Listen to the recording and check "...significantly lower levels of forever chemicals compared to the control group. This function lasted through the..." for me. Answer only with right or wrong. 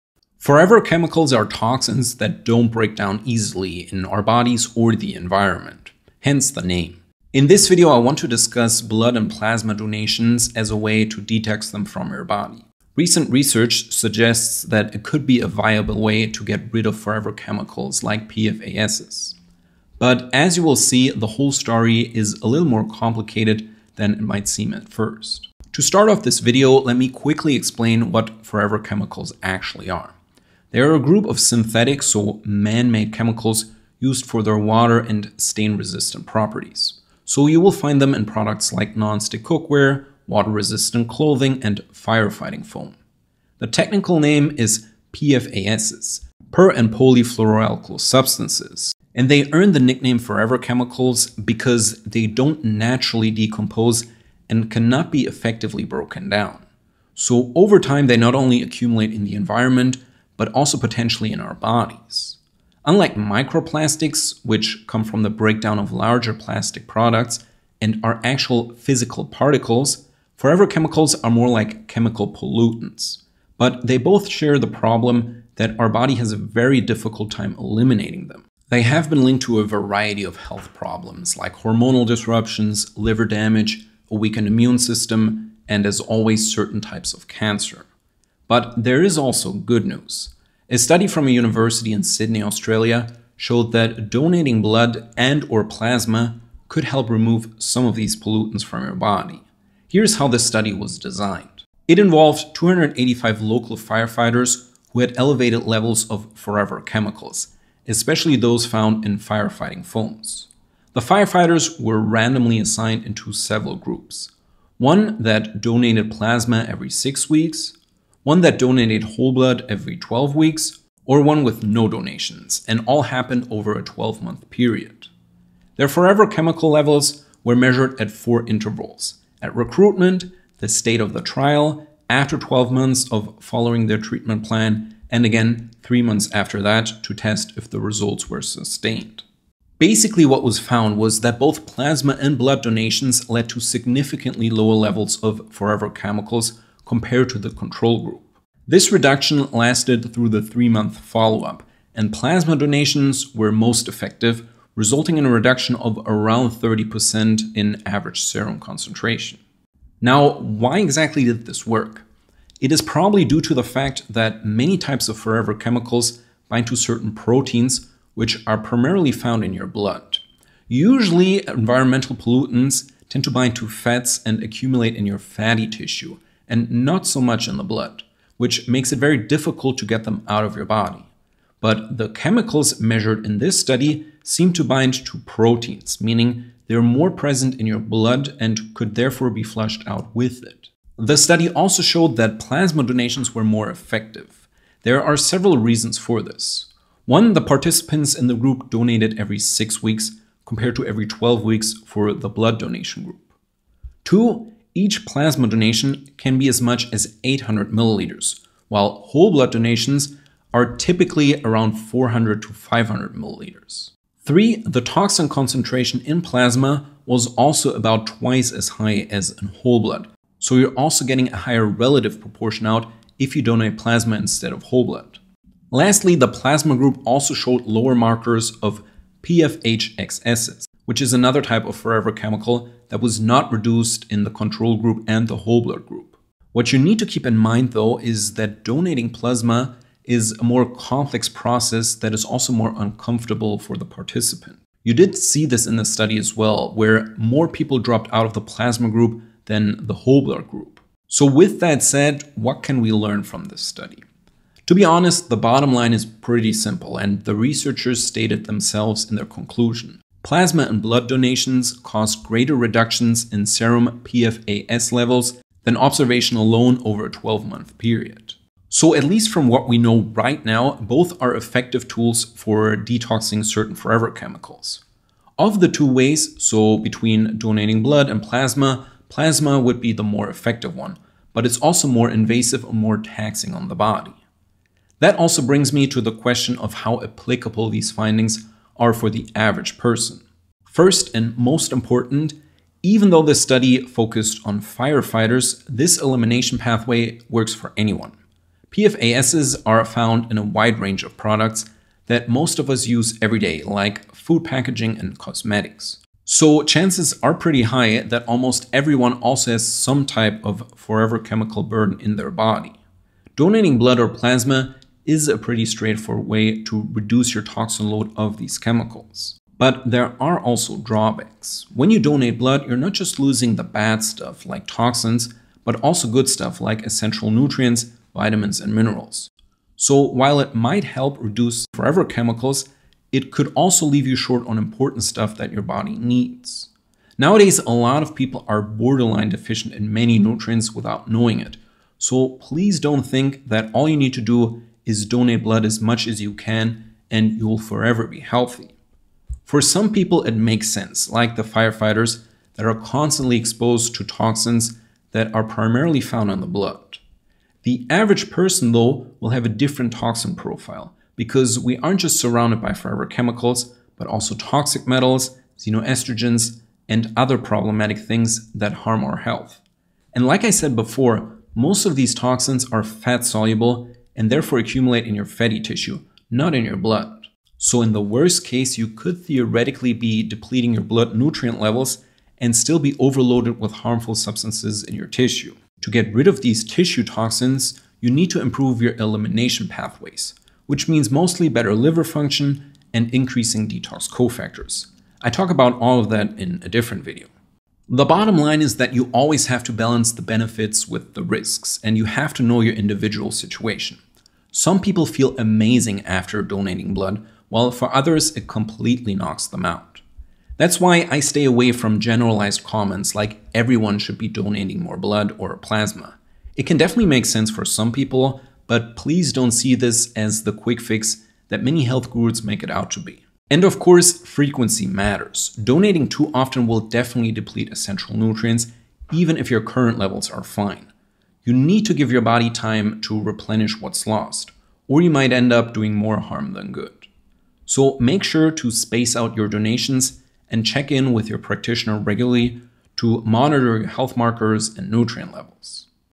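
wrong.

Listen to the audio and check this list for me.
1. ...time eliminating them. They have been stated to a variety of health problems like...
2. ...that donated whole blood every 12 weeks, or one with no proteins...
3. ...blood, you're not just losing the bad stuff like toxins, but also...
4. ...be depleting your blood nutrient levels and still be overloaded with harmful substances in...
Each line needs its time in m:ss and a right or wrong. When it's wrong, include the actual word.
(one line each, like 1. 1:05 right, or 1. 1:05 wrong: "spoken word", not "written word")
1. 1:17 wrong: "linked", not "stated"
2. 1:58 wrong: "donations", not "proteins"
3. 5:22 right
4. 6:19 right.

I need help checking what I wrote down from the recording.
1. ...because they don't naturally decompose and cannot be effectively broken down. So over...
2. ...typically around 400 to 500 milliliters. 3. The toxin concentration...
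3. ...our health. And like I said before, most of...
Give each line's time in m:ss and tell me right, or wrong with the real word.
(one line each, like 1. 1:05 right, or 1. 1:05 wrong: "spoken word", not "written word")
1. 0:51 right
2. 3:30 right
3. 6:09 right.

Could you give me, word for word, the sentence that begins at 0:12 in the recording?
Recent research suggests that it could be a viable way to get rid of forever chemicals like PFASs.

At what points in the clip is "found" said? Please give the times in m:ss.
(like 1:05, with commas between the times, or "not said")
1:48, 2:20, 2:49, 4:59, 5:55.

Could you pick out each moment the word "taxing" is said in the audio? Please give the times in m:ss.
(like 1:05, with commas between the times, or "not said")
4:42.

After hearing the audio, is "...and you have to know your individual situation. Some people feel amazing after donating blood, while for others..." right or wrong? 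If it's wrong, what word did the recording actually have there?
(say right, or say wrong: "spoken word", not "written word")
right.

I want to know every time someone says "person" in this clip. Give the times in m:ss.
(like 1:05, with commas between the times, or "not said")
4:49, 5:58.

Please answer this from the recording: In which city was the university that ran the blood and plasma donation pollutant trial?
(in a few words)
Sydney.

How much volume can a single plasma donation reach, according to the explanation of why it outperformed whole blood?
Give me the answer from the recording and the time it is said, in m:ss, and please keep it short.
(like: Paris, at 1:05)
800 milliliters, at 3:27.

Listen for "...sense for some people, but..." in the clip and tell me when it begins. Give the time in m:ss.
6:57.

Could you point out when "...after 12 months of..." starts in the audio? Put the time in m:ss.
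2:12.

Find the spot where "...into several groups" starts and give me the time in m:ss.
1:53.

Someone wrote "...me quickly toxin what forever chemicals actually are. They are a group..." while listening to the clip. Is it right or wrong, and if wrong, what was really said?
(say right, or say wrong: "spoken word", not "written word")
wrong: "explain", not "toxin".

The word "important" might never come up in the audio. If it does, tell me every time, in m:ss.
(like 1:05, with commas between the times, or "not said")
4:51, 5:34.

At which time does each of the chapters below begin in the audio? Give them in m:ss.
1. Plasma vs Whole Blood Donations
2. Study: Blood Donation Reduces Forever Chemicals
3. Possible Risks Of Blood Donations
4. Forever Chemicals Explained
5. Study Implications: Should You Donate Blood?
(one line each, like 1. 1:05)
1. 3:17
2. 1:29
3. 5:20
4. 0:30
5. 4:11.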